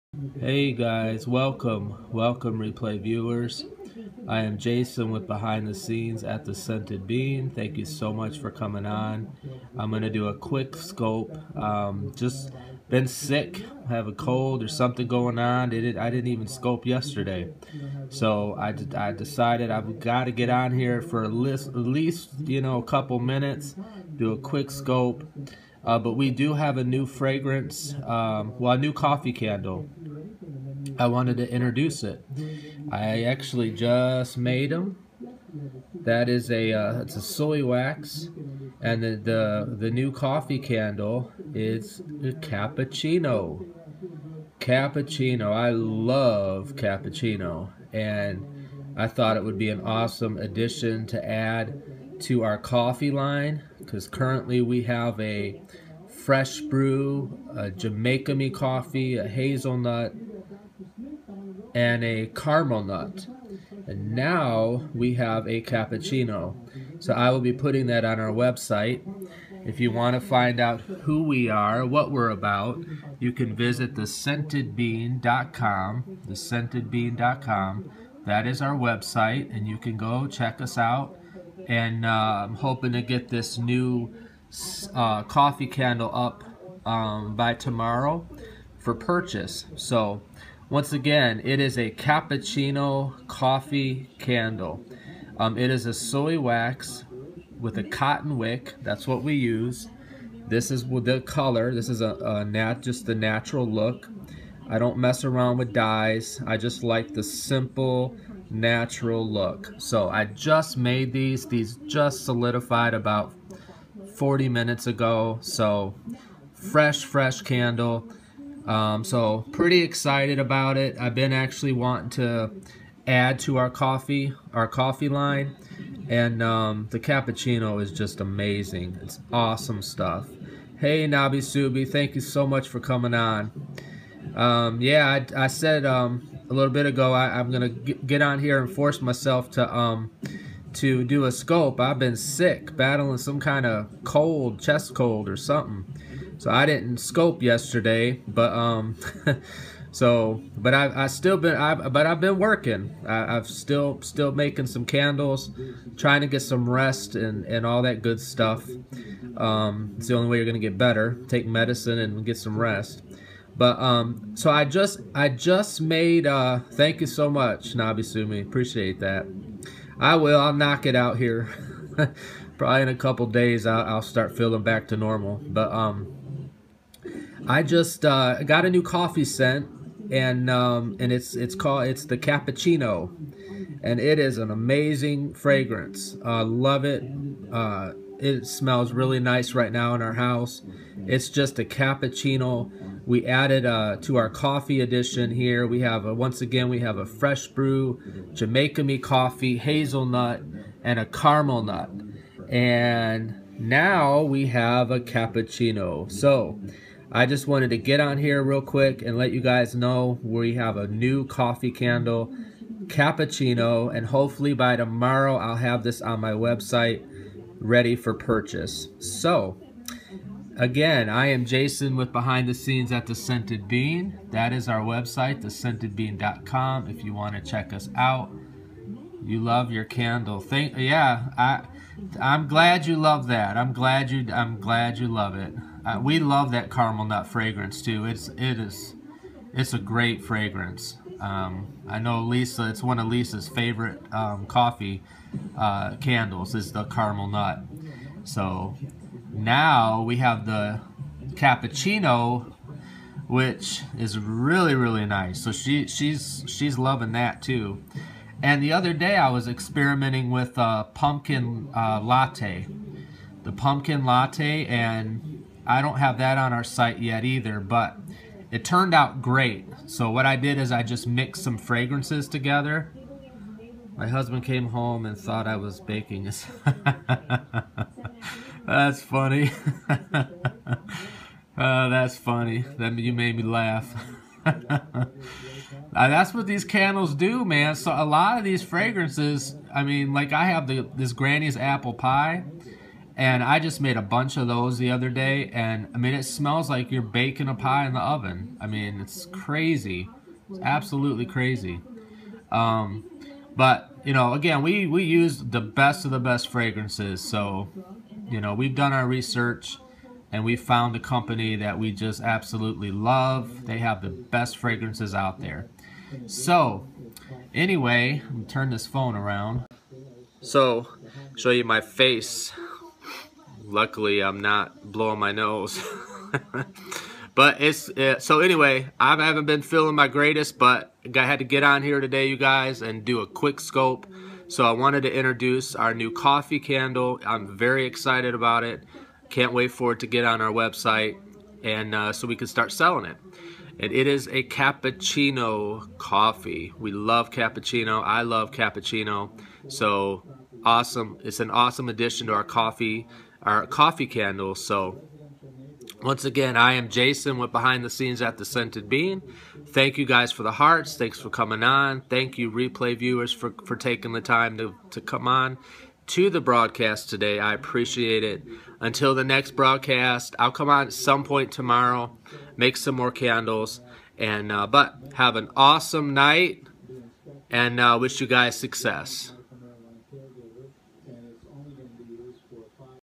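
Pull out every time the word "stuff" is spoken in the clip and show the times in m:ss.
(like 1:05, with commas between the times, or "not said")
2:09, 2:38.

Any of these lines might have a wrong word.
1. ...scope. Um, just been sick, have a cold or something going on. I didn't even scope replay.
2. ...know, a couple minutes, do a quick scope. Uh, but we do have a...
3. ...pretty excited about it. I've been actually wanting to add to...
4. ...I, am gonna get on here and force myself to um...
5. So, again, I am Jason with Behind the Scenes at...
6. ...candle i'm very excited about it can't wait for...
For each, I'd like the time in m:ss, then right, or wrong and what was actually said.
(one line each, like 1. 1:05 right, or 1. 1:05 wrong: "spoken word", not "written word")
1. 0:10 wrong: "yesterday", not "replay"
2. 0:22 right
3. 1:59 right
4. 2:17 right
5. 3:38 right
6. 5:36 right.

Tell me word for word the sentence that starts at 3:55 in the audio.
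Uh, we love that caramel nut fragrance too.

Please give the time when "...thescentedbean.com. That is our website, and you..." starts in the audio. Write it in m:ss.
1:16.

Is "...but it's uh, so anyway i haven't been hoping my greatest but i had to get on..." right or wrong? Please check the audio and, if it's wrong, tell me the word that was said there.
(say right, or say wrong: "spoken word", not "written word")
wrong: "feeling", not "hoping".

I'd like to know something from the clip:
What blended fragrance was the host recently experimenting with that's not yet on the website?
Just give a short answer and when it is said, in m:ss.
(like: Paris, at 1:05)
pumpkin latte, at 4:23.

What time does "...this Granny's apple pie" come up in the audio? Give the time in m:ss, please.
4:50.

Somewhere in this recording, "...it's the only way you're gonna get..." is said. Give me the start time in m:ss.
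2:39.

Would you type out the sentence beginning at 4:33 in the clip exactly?
My husband came home and thought I was baking.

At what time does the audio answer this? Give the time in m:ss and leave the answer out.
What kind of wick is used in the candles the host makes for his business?
1:37.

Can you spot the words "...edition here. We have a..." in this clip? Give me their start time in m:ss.
3:14.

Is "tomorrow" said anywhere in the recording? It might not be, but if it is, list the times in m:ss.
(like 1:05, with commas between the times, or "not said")
1:27, 3:34, 6:11.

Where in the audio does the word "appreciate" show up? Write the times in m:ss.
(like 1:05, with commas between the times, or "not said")
2:48, 6:07.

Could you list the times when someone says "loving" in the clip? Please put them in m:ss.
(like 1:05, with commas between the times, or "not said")
4:16.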